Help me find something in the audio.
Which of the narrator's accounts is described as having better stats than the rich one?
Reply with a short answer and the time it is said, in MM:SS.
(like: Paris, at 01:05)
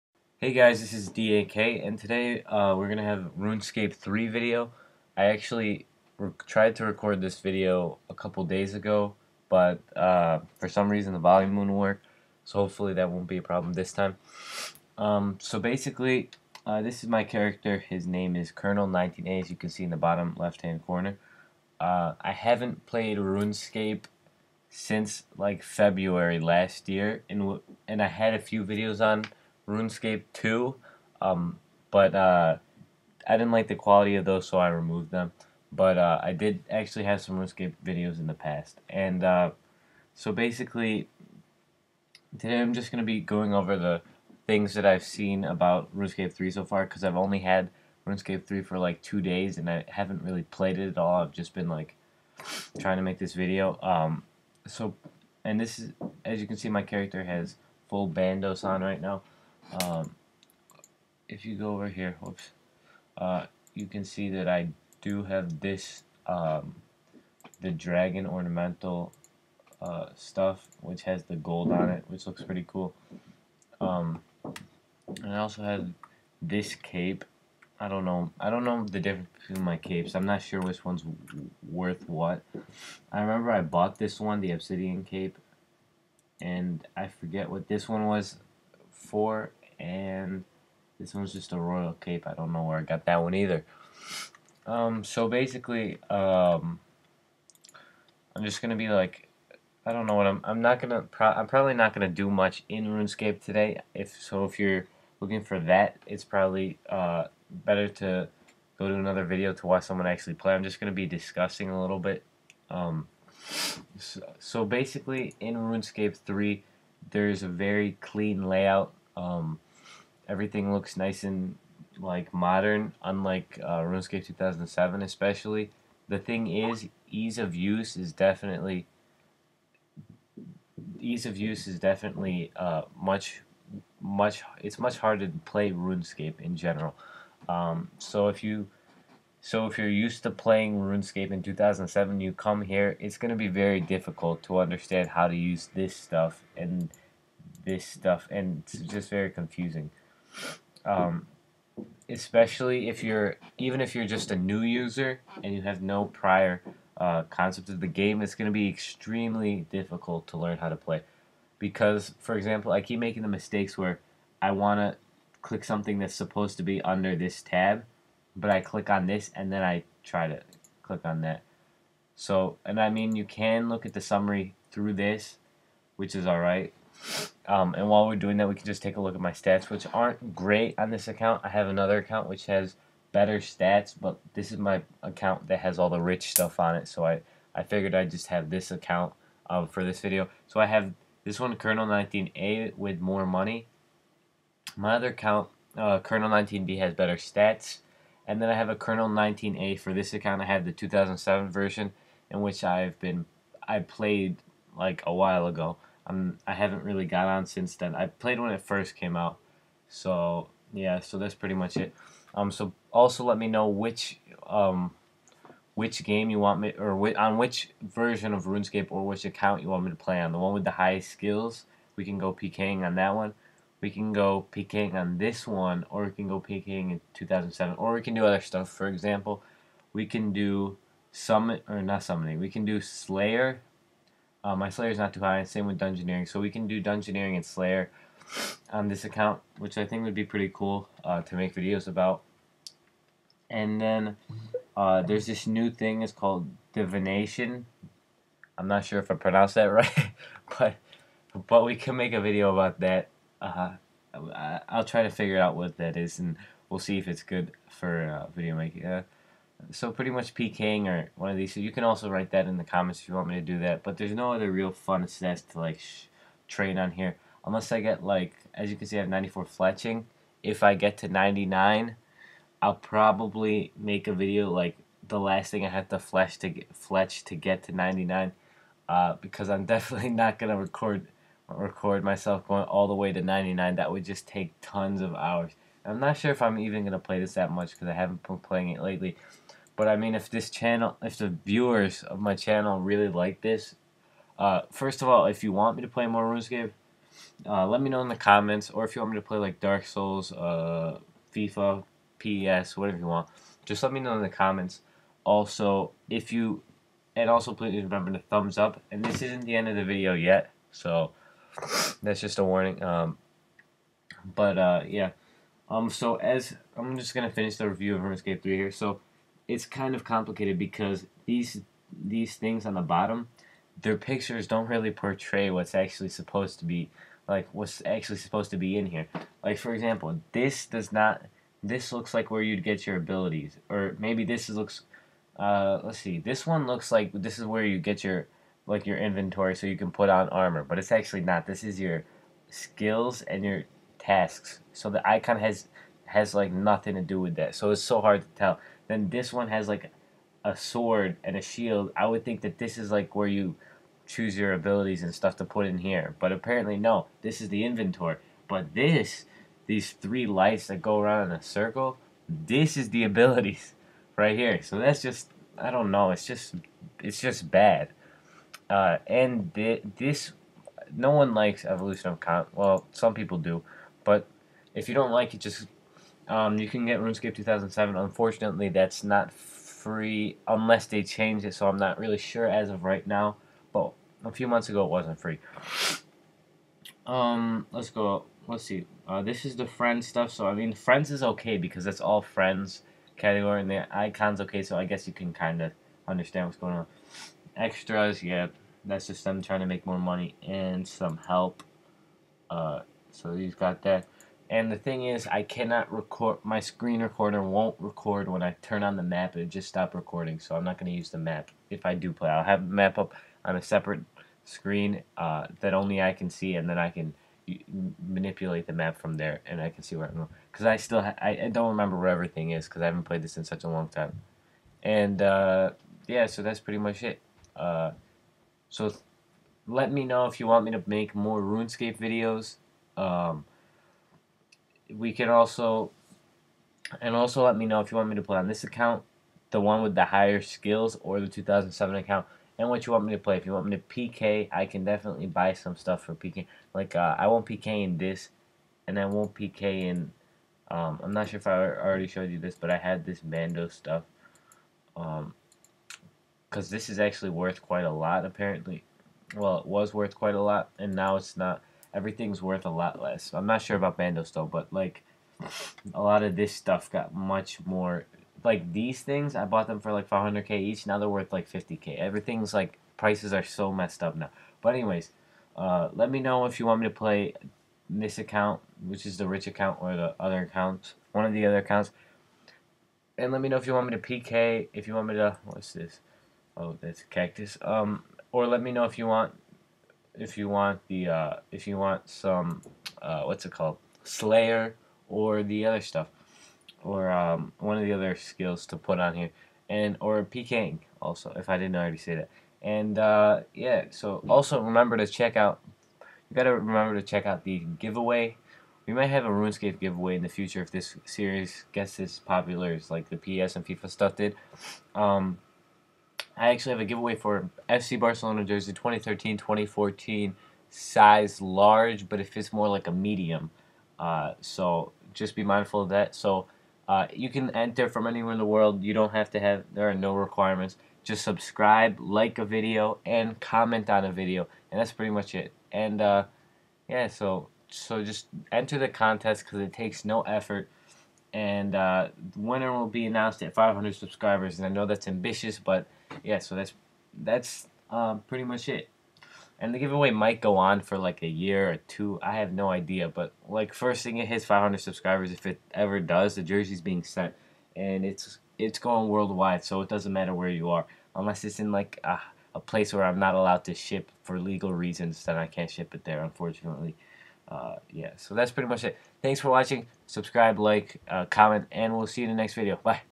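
Colonel 19B, at 03:15.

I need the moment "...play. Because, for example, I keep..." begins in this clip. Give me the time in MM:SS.
02:40.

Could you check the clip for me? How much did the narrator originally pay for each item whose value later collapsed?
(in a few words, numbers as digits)
500k.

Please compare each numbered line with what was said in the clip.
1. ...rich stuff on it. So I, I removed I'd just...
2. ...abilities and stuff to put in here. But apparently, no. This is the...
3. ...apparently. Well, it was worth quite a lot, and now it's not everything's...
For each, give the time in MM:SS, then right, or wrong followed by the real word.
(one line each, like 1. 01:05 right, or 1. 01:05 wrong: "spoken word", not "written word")
1. 03:06 wrong: "figured", not "removed"
2. 05:54 right
3. 07:38 right.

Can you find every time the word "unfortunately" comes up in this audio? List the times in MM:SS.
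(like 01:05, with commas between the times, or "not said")
06:17, 09:26.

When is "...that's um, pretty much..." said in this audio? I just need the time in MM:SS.
09:07.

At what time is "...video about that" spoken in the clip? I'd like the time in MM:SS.
04:12.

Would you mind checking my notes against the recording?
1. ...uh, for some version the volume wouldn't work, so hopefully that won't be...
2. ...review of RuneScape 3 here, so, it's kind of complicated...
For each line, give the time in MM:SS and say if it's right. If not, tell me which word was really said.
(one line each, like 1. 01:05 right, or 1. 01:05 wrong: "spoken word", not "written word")
1. 00:09 wrong: "reason", not "version"
2. 05:17 right.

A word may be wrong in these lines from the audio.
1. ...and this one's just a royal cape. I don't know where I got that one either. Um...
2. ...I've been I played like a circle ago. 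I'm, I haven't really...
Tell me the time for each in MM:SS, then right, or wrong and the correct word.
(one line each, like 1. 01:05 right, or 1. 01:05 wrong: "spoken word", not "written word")
1. 01:29 right
2. 03:22 wrong: "while", not "circle".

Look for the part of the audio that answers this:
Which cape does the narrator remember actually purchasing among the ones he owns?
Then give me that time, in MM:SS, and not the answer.
01:24.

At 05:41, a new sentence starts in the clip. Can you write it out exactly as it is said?
This is your skills and your tasks.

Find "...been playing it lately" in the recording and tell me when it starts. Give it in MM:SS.
04:48.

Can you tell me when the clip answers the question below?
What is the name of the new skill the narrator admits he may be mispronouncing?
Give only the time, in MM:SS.
04:06.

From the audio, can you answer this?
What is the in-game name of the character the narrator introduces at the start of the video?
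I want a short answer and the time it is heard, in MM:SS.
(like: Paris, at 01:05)
Colonel19A, at 00:18.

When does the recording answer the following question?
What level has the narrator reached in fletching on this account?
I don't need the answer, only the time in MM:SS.
04:29.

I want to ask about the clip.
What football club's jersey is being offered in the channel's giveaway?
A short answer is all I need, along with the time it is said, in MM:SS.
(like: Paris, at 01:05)
FC Barcelona, at 08:37.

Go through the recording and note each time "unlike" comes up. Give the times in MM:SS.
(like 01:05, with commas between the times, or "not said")
02:03.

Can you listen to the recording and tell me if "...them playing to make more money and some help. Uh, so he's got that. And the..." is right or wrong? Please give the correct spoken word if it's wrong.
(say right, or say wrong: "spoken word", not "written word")
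wrong: "trying", not "playing".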